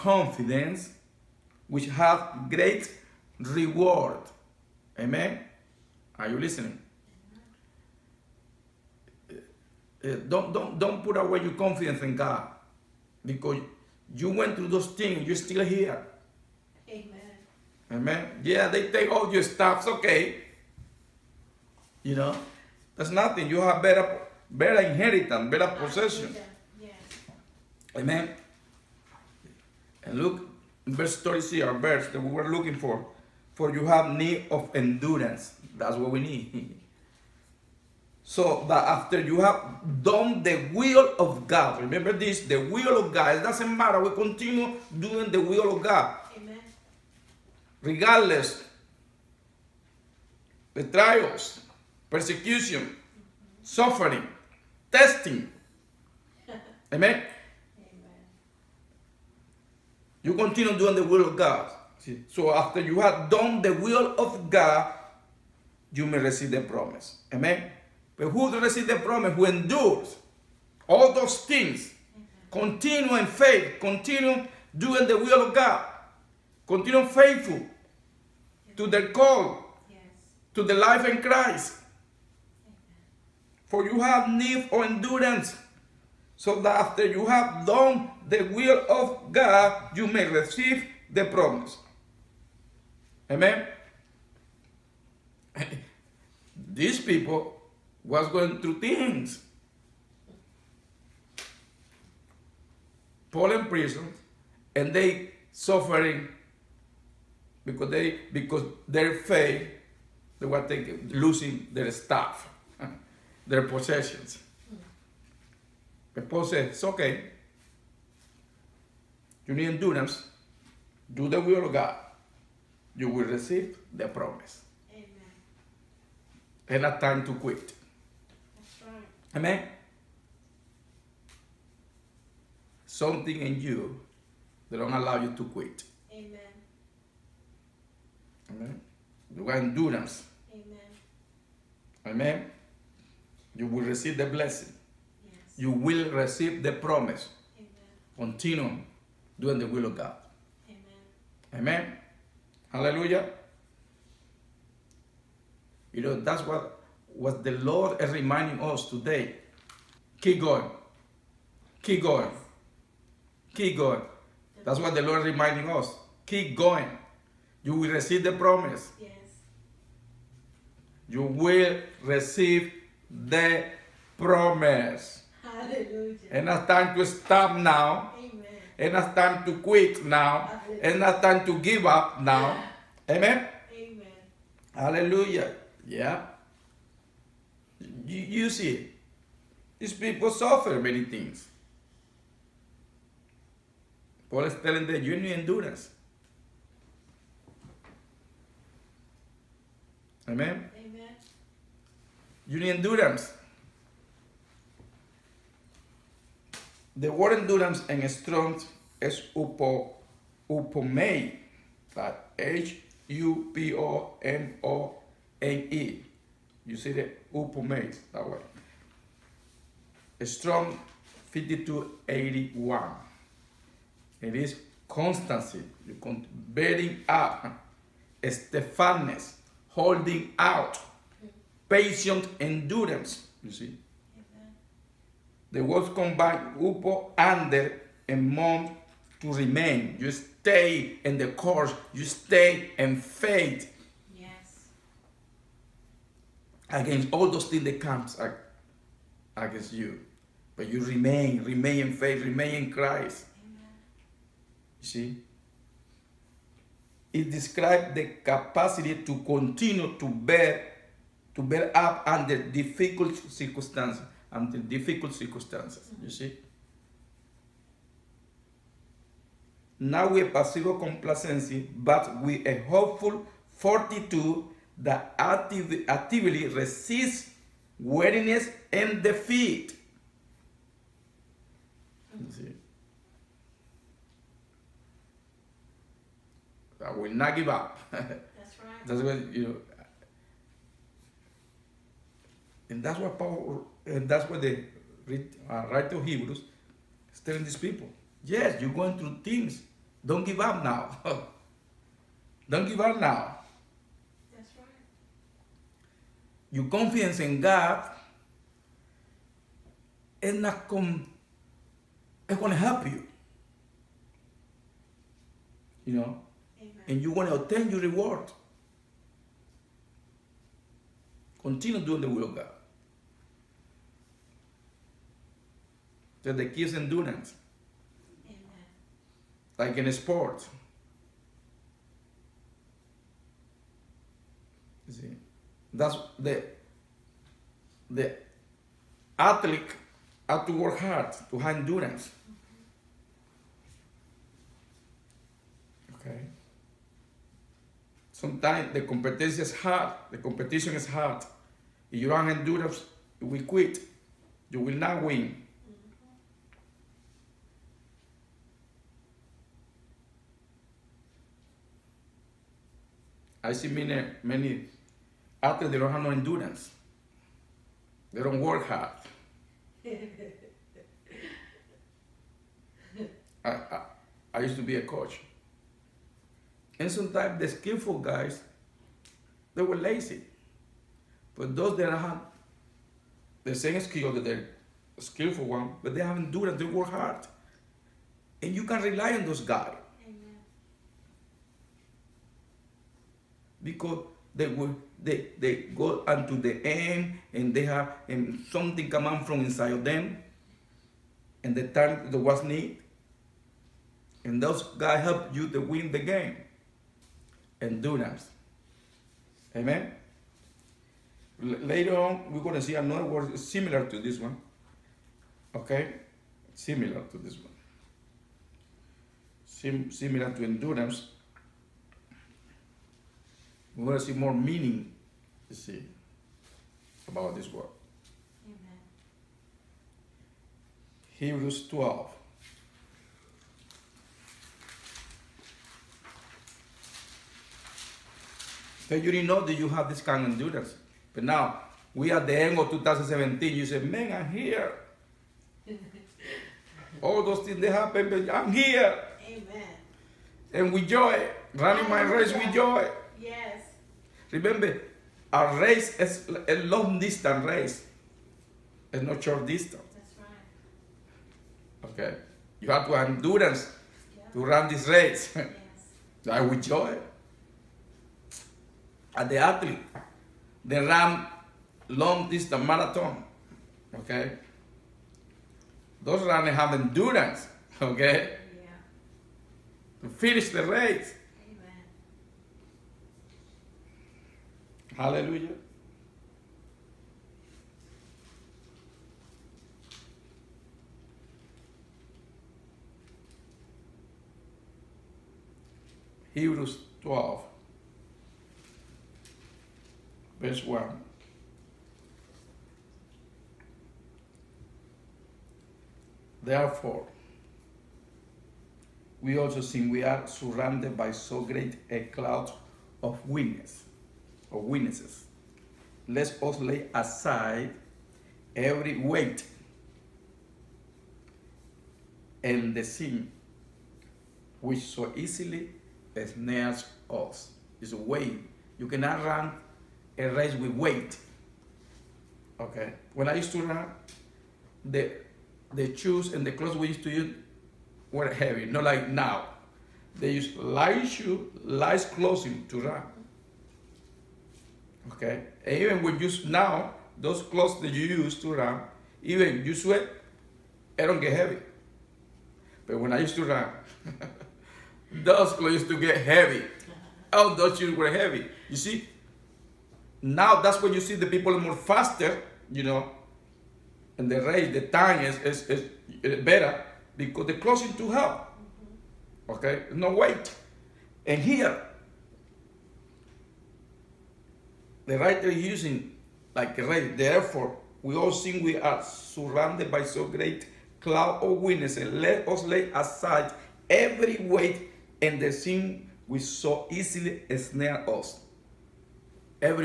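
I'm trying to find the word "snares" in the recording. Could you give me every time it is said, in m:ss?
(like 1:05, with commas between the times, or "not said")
8:46, 9:47.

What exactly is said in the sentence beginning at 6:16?
And sometimes the skillful guys, they were lazy.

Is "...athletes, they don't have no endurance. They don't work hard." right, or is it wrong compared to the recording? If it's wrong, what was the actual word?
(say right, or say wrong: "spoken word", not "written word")
right.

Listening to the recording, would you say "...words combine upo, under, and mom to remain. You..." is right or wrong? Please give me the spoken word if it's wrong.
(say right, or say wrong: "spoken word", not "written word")
right.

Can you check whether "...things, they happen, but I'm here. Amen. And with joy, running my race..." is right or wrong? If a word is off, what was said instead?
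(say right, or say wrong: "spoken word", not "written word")
right.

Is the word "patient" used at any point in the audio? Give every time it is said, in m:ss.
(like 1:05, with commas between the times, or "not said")
3:51.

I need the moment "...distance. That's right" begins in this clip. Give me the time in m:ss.
7:39.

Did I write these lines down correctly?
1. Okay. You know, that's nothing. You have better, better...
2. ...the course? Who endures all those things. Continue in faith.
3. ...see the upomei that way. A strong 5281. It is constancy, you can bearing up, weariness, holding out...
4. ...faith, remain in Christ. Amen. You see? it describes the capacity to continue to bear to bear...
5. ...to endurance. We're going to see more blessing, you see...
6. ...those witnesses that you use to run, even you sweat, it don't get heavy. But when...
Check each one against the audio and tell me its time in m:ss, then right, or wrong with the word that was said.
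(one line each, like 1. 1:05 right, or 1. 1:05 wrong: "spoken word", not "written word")
1. 0:19 right
2. 1:08 wrong: "promise", not "course"
3. 3:36 wrong: "steadfastness", not "weariness"
4. 4:11 right
5. 7:00 wrong: "meaning", not "blessing"
6. 9:07 wrong: "clothes", not "witnesses".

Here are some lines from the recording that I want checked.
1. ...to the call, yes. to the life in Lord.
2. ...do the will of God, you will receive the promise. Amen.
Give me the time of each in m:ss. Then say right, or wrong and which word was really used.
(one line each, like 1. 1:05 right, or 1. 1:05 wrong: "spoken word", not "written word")
1. 1:18 wrong: "Christ", not "Lord"
2. 2:01 right.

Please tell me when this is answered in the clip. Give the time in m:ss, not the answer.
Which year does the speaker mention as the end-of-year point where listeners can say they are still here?
7:22.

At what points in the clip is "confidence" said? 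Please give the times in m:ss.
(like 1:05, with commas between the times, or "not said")
0:11, 5:06.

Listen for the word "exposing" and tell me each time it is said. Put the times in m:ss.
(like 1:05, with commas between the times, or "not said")
not said.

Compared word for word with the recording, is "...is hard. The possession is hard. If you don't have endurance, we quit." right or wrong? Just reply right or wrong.
wrong.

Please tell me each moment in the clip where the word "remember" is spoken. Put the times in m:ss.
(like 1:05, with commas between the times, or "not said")
0:41, 7:34.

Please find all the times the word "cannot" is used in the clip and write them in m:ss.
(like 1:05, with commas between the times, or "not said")
8:48.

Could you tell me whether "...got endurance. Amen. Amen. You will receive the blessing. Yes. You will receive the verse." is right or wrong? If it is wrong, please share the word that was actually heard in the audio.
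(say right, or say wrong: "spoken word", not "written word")
wrong: "promise", not "verse".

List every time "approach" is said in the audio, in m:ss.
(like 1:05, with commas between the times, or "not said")
not said.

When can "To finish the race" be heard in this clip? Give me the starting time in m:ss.
8:00.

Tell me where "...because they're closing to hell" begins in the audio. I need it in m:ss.
9:27.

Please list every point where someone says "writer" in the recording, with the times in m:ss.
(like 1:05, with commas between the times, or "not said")
4:55, 9:35.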